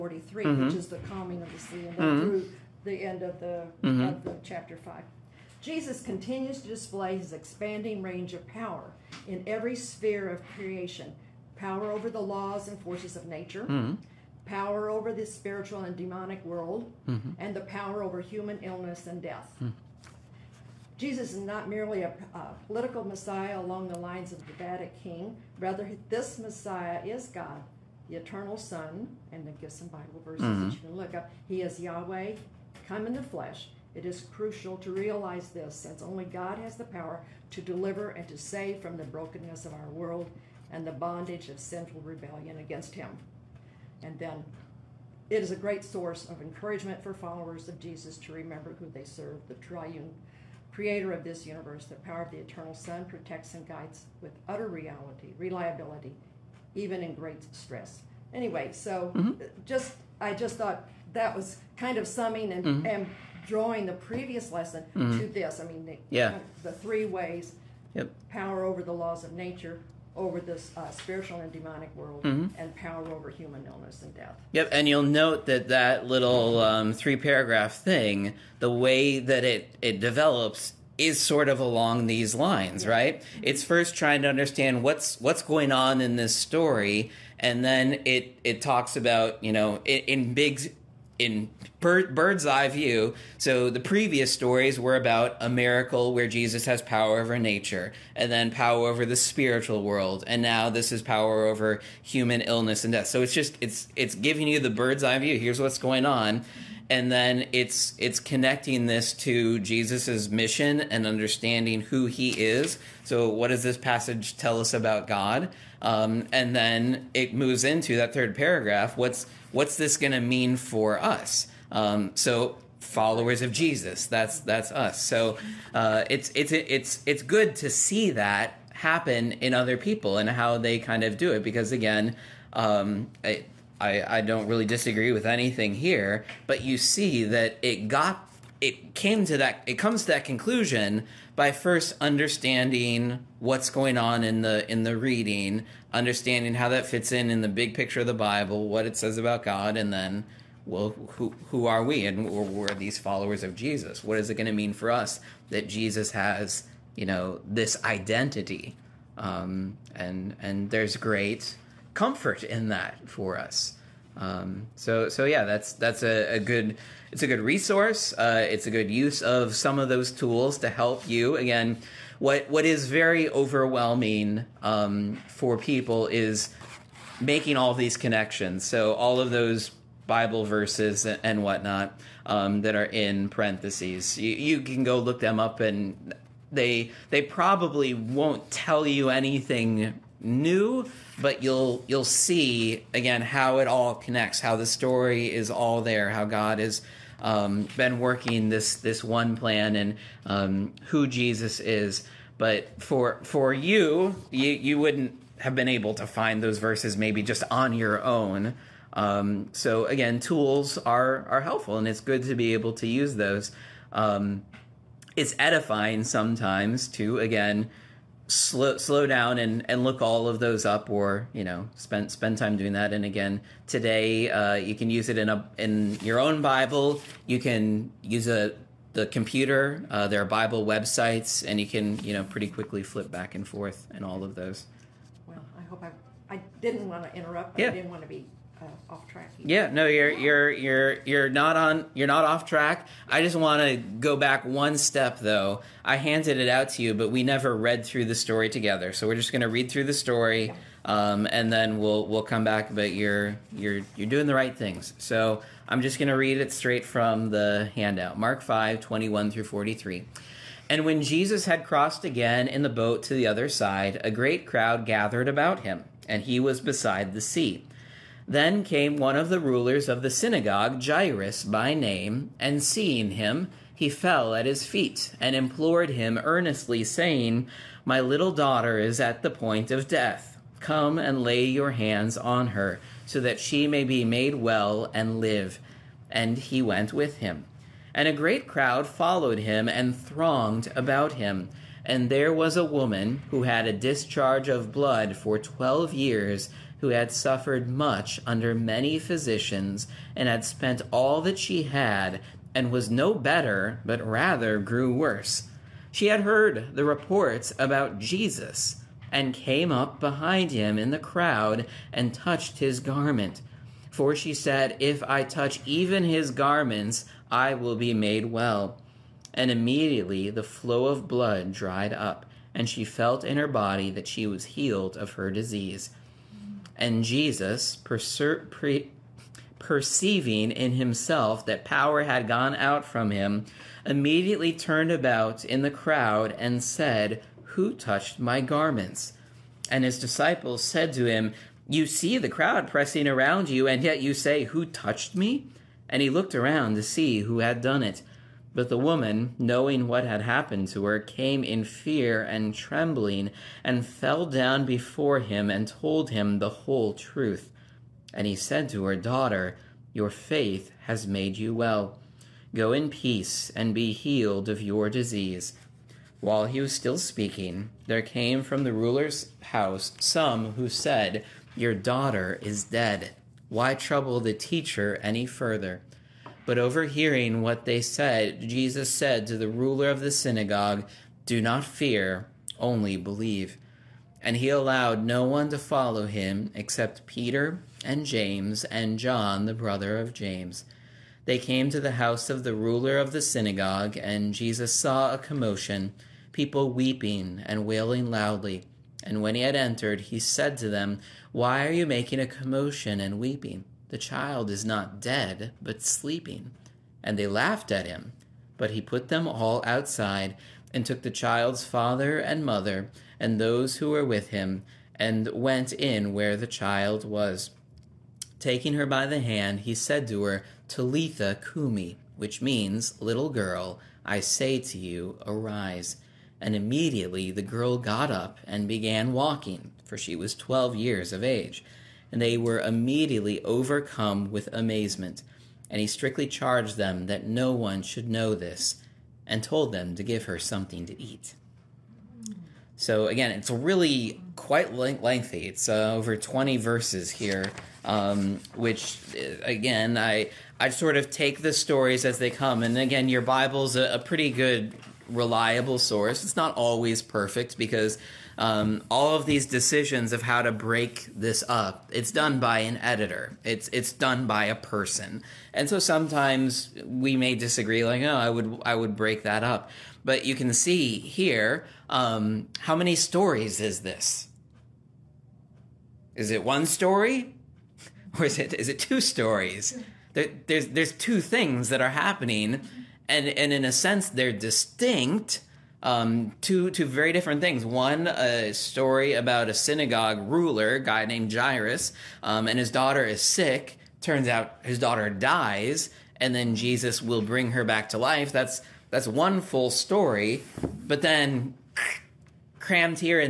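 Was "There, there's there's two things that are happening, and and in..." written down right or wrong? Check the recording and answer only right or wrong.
right.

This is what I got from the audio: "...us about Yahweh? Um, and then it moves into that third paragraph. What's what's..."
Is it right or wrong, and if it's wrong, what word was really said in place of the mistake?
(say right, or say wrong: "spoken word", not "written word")
wrong: "God", not "Yahweh".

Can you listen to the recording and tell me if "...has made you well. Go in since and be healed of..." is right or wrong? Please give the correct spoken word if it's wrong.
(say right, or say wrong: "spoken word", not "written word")
wrong: "peace", not "since".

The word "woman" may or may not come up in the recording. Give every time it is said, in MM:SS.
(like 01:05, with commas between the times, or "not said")
04:52, 05:48.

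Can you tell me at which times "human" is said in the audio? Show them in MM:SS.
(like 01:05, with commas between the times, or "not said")
00:18, 01:13, 01:42.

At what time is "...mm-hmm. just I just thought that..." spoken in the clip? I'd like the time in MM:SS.
00:59.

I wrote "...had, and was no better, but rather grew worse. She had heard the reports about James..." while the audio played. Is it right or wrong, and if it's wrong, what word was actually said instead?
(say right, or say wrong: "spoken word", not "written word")
wrong: "Jesus", not "James".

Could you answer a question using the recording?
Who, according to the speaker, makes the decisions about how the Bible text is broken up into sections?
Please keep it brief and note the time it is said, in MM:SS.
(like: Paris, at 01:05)
an editor, at 07:42.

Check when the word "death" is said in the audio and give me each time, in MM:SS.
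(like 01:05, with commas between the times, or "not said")
00:19, 01:14, 01:42, 04:39.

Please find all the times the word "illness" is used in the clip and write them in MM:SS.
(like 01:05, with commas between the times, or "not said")
00:18, 01:13, 01:42.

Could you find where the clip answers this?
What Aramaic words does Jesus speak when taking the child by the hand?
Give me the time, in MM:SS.
07:00.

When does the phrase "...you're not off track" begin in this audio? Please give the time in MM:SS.
04:01.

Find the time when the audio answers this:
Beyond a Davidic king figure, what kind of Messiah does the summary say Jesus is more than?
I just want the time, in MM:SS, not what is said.
00:22.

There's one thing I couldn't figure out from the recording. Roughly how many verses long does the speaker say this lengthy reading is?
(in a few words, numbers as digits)
over 20.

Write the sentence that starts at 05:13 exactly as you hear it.
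For she said, If I touch even his garments, I will be made well.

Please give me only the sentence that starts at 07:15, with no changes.
And he strictly charged them that no one should know this, and told them to give her something to eat.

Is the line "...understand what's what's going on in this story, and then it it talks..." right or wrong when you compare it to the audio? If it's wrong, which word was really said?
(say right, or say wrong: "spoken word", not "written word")
right.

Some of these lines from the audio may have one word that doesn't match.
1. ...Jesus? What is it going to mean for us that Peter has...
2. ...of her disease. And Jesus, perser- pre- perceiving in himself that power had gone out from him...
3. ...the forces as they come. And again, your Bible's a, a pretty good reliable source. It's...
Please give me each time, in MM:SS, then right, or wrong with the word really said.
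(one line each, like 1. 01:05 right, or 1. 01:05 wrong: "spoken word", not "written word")
1. 02:33 wrong: "Jesus", not "Peter"
2. 05:24 right
3. 07:31 wrong: "stories", not "forces".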